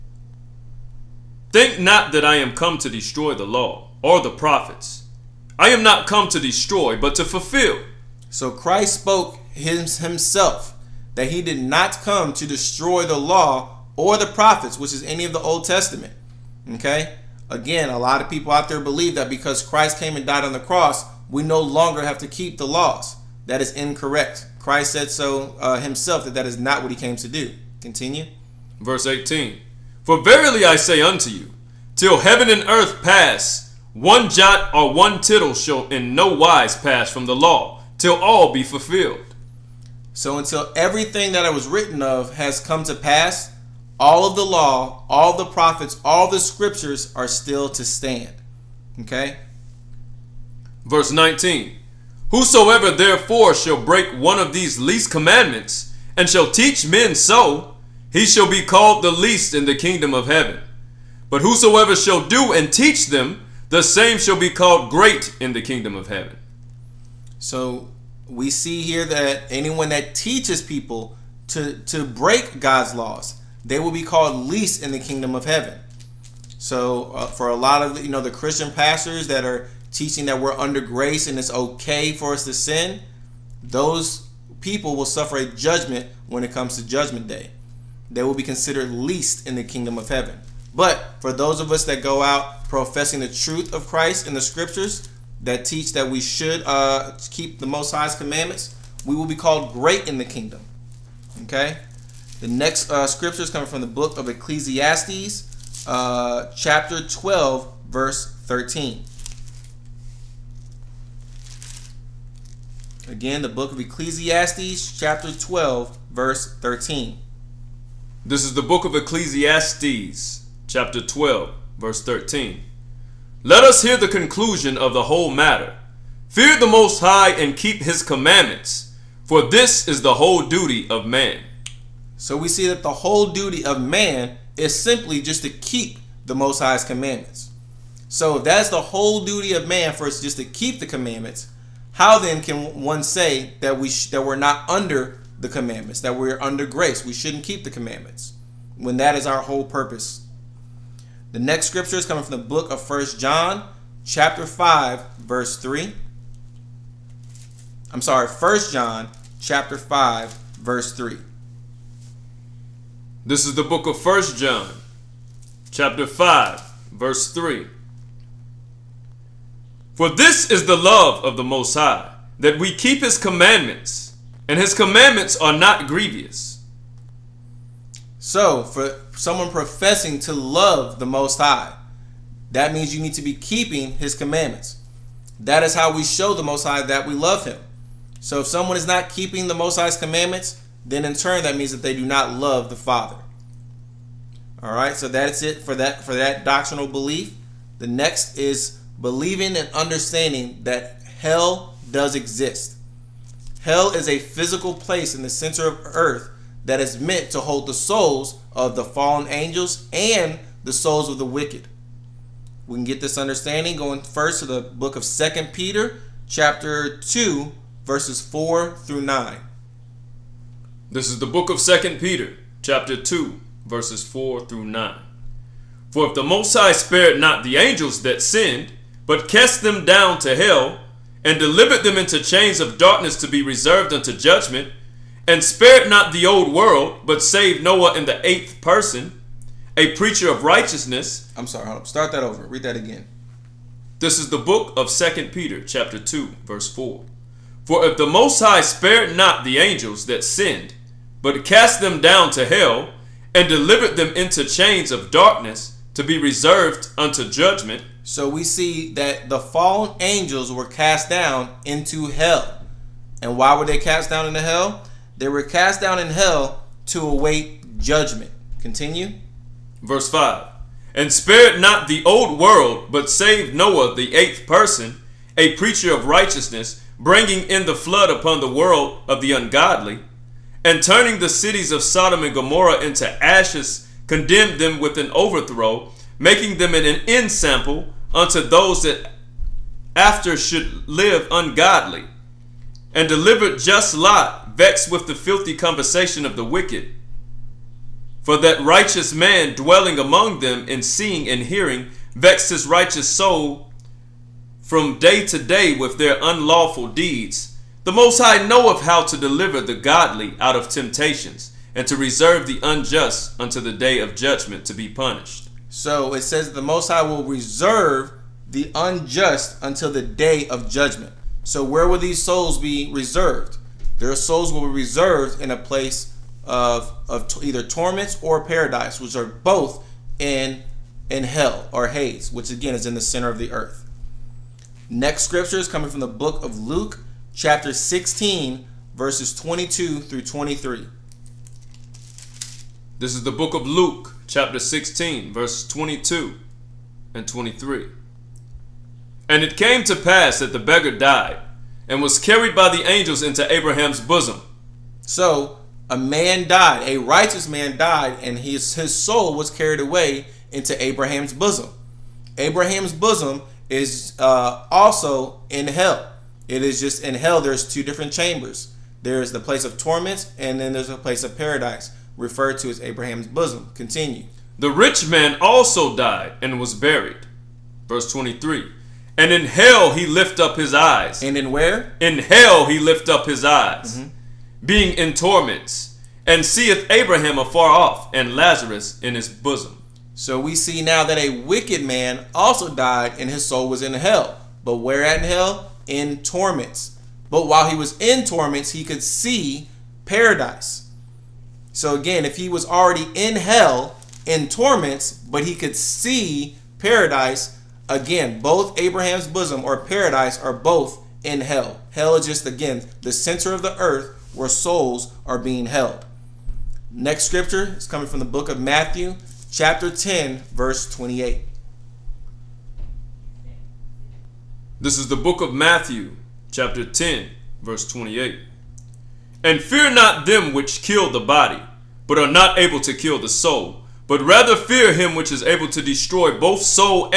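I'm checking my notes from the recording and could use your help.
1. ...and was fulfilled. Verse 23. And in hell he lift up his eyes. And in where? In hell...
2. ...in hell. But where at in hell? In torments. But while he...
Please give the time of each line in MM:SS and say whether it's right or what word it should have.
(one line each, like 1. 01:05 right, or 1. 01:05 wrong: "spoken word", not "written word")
1. 06:16 wrong: "buried", not "fulfilled"
2. 06:33 right.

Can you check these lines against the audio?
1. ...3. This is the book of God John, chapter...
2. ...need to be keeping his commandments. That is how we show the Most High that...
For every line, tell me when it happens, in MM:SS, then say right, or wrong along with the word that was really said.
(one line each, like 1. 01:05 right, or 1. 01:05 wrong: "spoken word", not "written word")
1. 02:40 wrong: "First", not "God"
2. 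03:03 right.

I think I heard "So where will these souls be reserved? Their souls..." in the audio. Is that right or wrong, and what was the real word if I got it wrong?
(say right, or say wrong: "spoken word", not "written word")
right.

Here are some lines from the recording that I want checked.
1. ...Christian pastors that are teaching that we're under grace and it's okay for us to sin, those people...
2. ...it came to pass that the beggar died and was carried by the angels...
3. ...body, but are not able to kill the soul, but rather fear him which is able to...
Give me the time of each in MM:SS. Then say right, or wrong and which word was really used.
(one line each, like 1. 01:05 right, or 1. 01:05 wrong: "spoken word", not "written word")
1. 01:18 right
2. 05:49 right
3. 07:11 right.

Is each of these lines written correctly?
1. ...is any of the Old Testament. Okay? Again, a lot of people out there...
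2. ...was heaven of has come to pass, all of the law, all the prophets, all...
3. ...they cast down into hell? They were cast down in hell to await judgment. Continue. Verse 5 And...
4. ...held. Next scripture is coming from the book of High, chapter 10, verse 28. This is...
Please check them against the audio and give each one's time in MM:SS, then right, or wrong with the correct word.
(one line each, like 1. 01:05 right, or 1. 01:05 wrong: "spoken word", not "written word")
1. 00:14 right
2. 00:41 wrong: "written", not "heaven"
3. 04:23 right
4. 06:55 wrong: "Matthew", not "High".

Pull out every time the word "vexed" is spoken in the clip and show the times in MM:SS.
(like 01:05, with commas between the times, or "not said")
04:54, 05:02.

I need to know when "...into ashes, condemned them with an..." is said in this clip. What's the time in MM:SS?
04:42.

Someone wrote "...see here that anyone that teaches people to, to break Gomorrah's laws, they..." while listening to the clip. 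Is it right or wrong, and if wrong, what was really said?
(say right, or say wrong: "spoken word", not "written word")
wrong: "God", not "Gomorrah".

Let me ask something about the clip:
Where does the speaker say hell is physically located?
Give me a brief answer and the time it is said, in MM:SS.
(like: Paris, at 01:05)
the center of earth, at 03:25.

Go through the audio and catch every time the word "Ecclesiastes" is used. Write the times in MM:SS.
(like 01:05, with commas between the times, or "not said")
01:44, 01:53, 01:58.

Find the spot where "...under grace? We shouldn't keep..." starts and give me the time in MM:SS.
02:26.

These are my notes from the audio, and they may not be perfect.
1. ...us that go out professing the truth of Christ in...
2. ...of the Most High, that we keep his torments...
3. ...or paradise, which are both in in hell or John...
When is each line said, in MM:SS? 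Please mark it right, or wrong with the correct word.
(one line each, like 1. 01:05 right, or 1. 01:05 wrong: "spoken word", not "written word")
1. 01:31 right
2. 02:51 wrong: "commandments", not "torments"
3. 05:28 wrong: "Hades", not "John".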